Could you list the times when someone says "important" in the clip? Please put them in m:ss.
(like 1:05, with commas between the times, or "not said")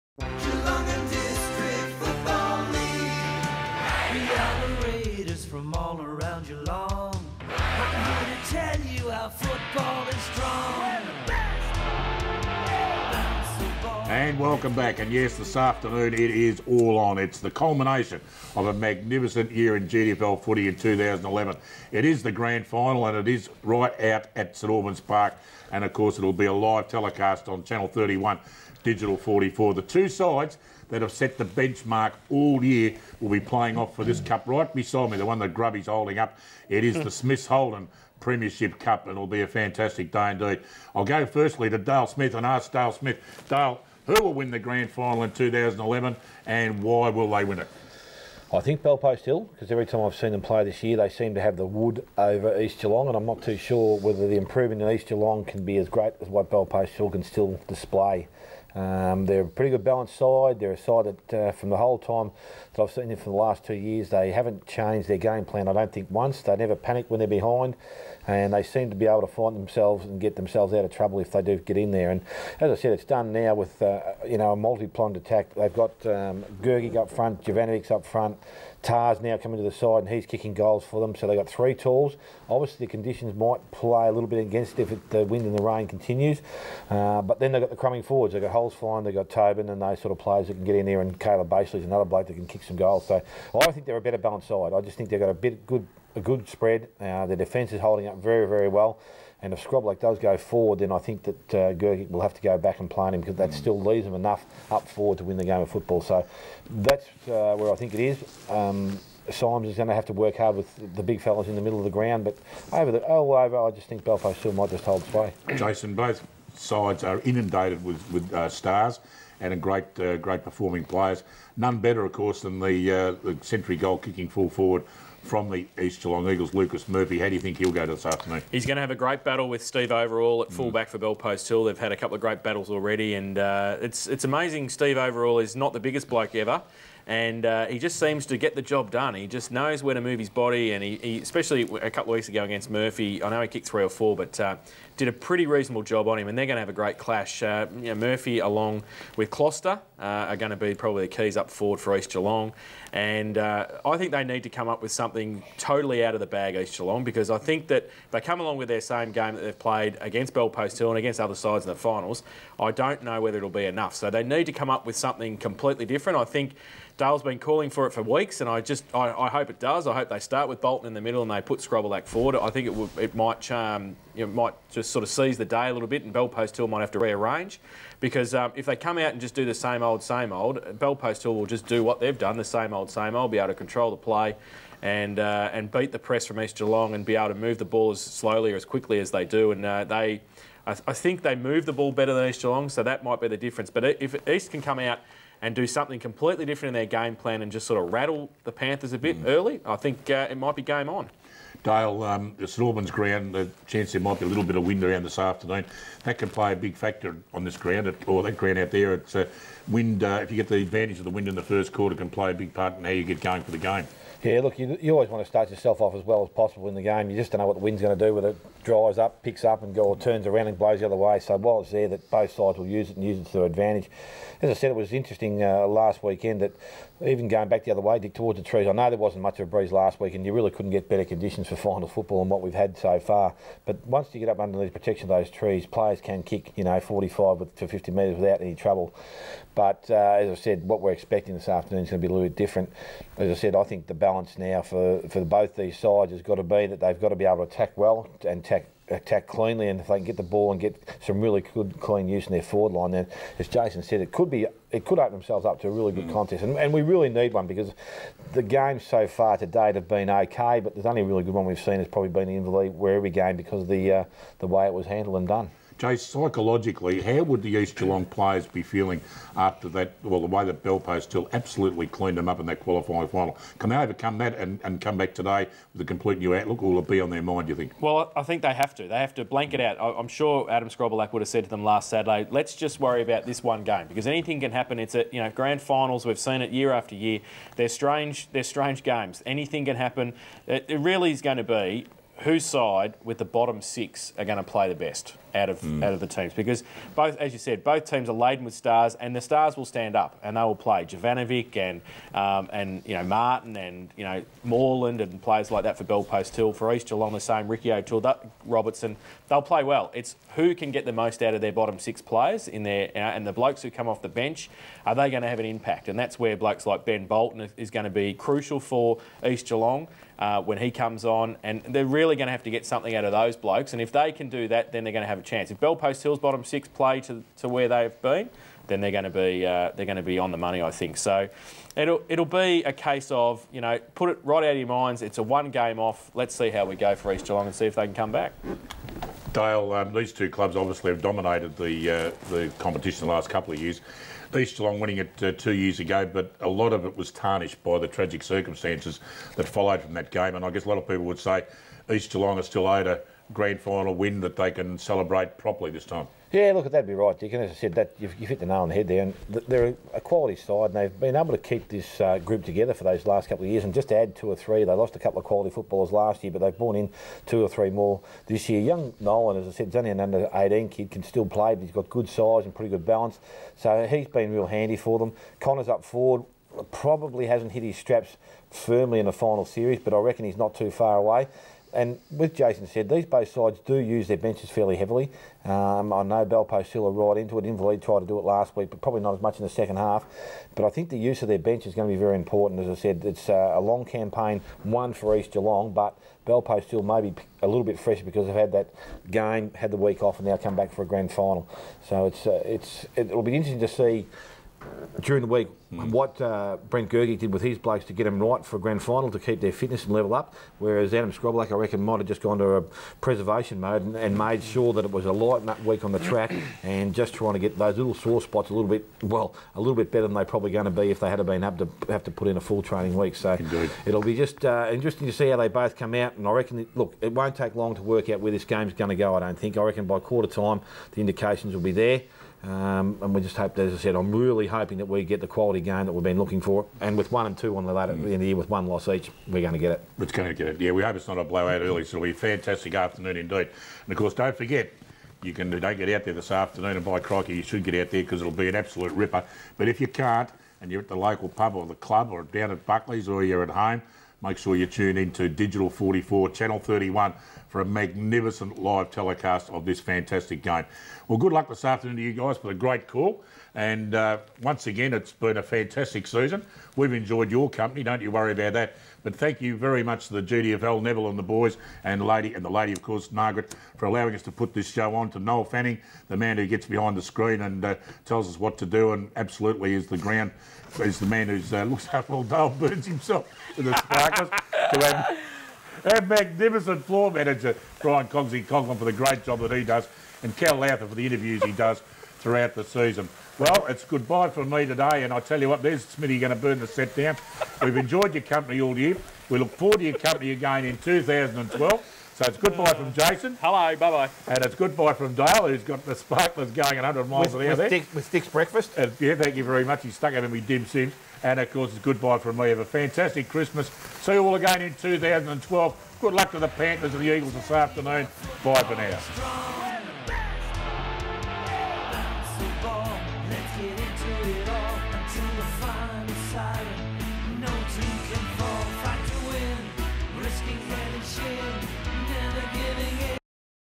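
6:32.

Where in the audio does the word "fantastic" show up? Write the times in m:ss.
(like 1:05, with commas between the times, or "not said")
0:39, 7:22, 7:39, 7:45, 8:32.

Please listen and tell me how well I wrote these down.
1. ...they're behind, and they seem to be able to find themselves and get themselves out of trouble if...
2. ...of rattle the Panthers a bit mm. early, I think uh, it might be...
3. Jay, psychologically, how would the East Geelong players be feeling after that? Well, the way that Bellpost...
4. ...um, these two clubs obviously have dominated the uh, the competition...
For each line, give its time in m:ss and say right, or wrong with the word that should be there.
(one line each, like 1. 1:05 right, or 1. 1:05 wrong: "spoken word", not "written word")
1. 1:07 right
2. 3:17 right
3. 4:25 right
4. 5:39 right.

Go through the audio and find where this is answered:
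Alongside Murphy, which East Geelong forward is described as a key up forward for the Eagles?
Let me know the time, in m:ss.
2:29.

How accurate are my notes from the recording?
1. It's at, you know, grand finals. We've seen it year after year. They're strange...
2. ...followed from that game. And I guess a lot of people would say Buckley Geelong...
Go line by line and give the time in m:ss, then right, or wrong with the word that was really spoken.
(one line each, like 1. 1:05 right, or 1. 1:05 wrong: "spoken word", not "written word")
1. 4:44 right
2. 5:49 wrong: "East", not "Buckley".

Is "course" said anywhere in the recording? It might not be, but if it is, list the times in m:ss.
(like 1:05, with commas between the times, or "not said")
0:25, 2:02, 7:23, 7:52, 8:31.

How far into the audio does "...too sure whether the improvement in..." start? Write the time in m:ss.
0:53.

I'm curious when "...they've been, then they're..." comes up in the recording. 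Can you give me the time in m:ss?
5:27.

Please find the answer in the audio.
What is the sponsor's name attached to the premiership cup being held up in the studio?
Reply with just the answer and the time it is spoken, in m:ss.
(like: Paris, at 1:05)
Smiths Holden, at 0:37.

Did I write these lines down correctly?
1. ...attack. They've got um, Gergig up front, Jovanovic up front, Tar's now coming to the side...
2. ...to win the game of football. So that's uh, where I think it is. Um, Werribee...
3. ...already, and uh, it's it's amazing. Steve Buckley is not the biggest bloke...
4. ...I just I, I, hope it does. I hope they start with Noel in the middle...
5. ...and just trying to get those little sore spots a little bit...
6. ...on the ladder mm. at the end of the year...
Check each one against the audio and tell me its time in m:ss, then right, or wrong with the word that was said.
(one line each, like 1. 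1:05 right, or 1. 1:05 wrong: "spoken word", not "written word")
1. 1:15 right
2. 1:45 wrong: "Symes", not "Werribee"
3. 2:12 wrong: "Overall", not "Buckley"
4. 2:48 wrong: "Bolton", not "Noel"
5. 6:56 right
6. 7:17 right.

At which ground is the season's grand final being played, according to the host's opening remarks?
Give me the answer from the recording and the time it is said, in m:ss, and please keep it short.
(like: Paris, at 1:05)
St Albans Park, at 0:24.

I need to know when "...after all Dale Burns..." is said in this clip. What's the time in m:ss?
8:01.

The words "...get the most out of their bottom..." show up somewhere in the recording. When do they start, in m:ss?
5:10.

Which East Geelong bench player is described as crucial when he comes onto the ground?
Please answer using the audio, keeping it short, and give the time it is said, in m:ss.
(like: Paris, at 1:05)
Ben Bolton, at 5:16.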